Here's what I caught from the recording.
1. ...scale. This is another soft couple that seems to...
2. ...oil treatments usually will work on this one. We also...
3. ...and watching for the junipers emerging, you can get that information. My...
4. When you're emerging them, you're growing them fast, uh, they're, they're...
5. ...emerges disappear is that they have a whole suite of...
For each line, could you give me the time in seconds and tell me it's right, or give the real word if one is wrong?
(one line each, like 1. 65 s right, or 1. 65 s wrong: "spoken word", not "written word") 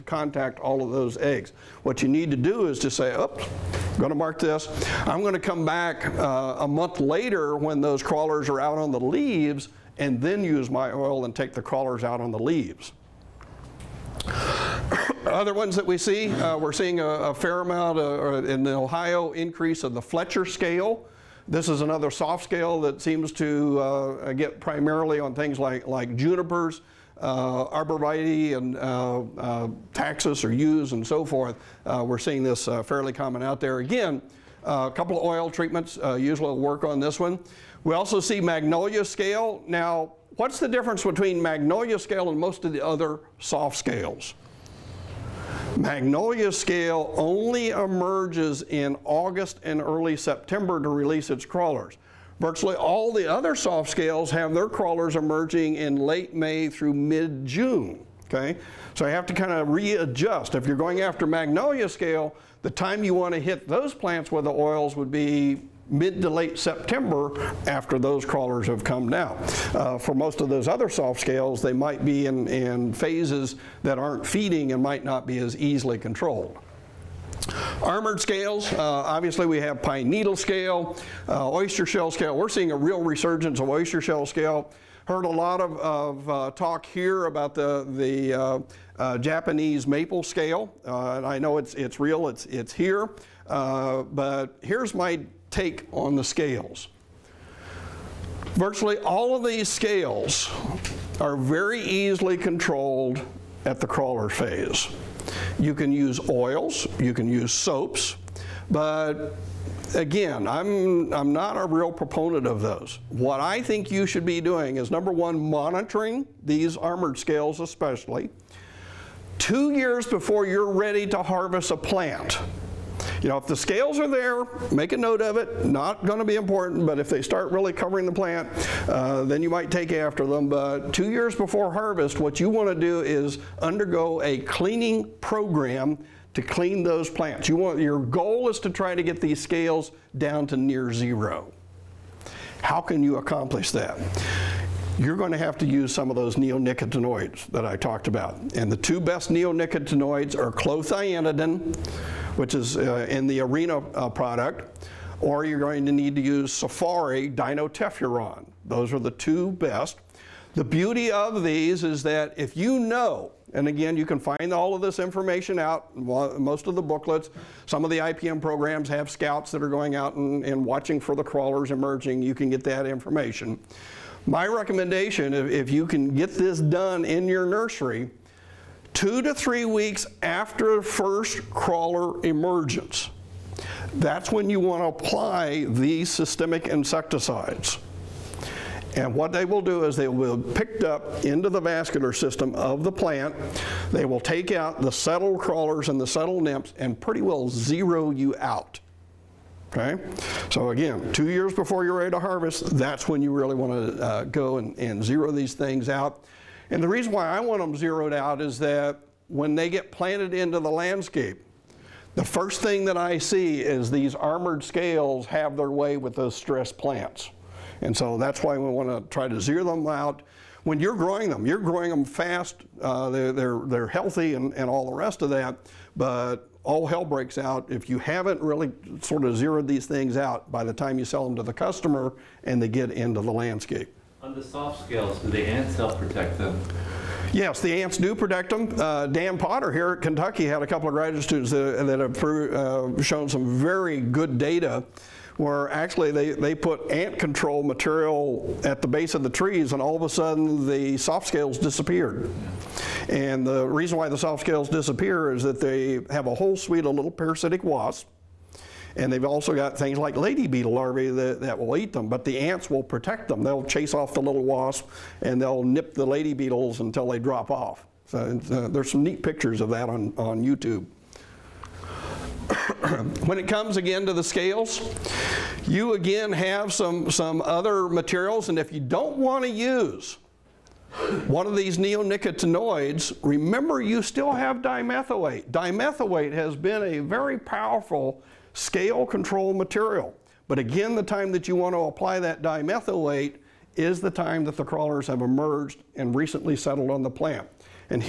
1. 20 s wrong: "scale", not "couple"
2. 35 s right
3. 170 s wrong: "crawlers", not "junipers"
4. 220 s wrong: "growing", not "emerging"
5. 254 s wrong: "scales", not "emerges".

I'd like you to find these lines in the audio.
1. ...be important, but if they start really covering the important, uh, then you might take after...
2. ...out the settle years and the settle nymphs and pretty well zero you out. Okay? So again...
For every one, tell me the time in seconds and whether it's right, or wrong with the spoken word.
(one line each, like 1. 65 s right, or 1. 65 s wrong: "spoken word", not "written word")
1. 126 s wrong: "plant", not "important"
2. 194 s wrong: "crawlers", not "years".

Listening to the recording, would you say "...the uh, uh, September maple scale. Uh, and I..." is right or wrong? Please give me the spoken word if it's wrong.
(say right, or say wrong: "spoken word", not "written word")
wrong: "Japanese", not "September".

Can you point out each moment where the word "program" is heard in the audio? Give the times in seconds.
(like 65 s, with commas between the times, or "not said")
135 s, 168 s.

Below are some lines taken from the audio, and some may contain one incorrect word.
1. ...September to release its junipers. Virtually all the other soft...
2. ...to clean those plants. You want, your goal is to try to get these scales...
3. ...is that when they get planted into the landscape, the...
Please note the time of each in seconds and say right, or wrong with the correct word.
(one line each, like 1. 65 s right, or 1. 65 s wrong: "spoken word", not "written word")
1. 50 s wrong: "crawlers", not "junipers"
2. 136 s right
3. 208 s right.